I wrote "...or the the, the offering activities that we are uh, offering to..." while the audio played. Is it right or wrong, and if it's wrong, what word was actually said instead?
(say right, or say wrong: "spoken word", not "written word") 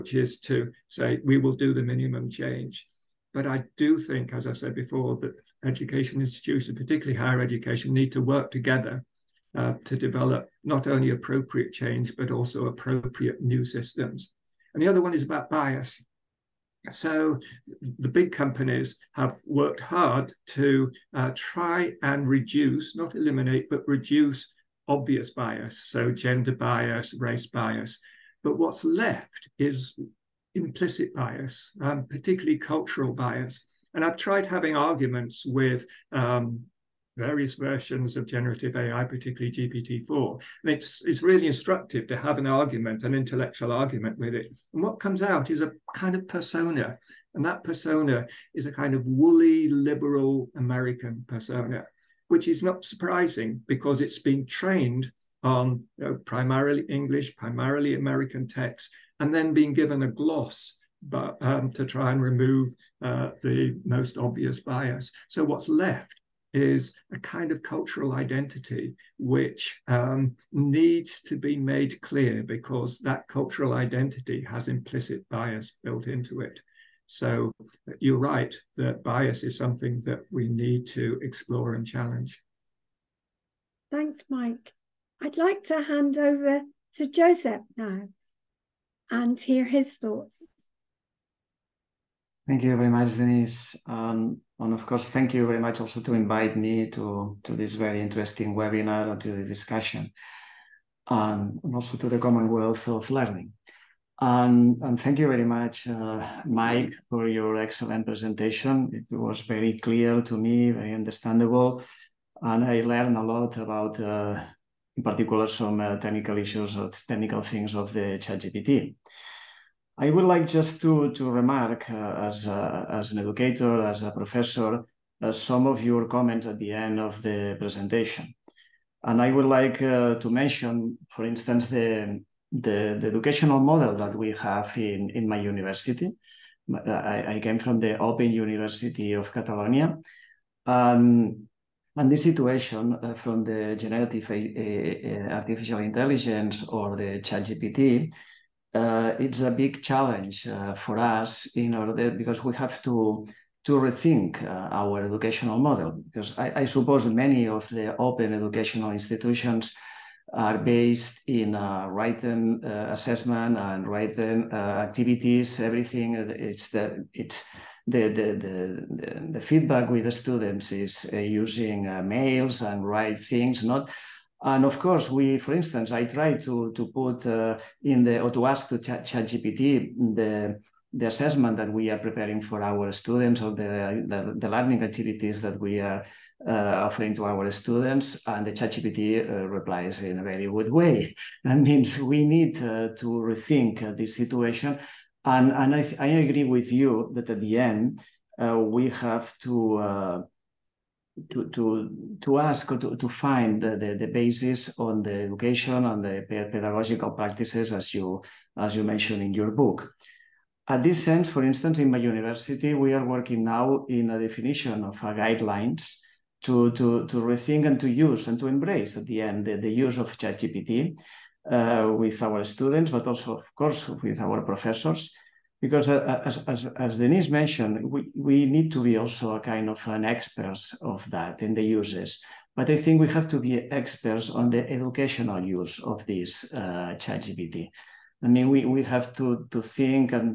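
wrong: "learning", not "offering".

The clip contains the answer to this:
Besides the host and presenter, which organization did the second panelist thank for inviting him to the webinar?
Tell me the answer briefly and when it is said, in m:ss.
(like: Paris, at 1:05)
Commonwealth of Learning, at 1:42.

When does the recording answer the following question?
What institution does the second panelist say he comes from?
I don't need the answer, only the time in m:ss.
2:17.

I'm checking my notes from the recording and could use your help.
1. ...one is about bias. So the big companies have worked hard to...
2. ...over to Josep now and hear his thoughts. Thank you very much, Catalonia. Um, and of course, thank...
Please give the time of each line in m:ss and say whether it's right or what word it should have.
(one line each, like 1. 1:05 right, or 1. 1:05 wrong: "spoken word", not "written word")
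1. 0:15 right
2. 1:26 wrong: "Denise", not "Catalonia".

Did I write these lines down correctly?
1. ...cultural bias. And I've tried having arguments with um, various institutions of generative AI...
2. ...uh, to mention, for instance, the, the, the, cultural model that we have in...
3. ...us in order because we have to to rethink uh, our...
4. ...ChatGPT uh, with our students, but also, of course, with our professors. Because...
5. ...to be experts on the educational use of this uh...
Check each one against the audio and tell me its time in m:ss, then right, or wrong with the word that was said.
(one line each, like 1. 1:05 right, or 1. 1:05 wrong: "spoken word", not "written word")
1. 0:32 wrong: "versions", not "institutions"
2. 2:09 wrong: "educational", not "cultural"
3. 2:30 right
4. 3:40 right
5. 3:53 right.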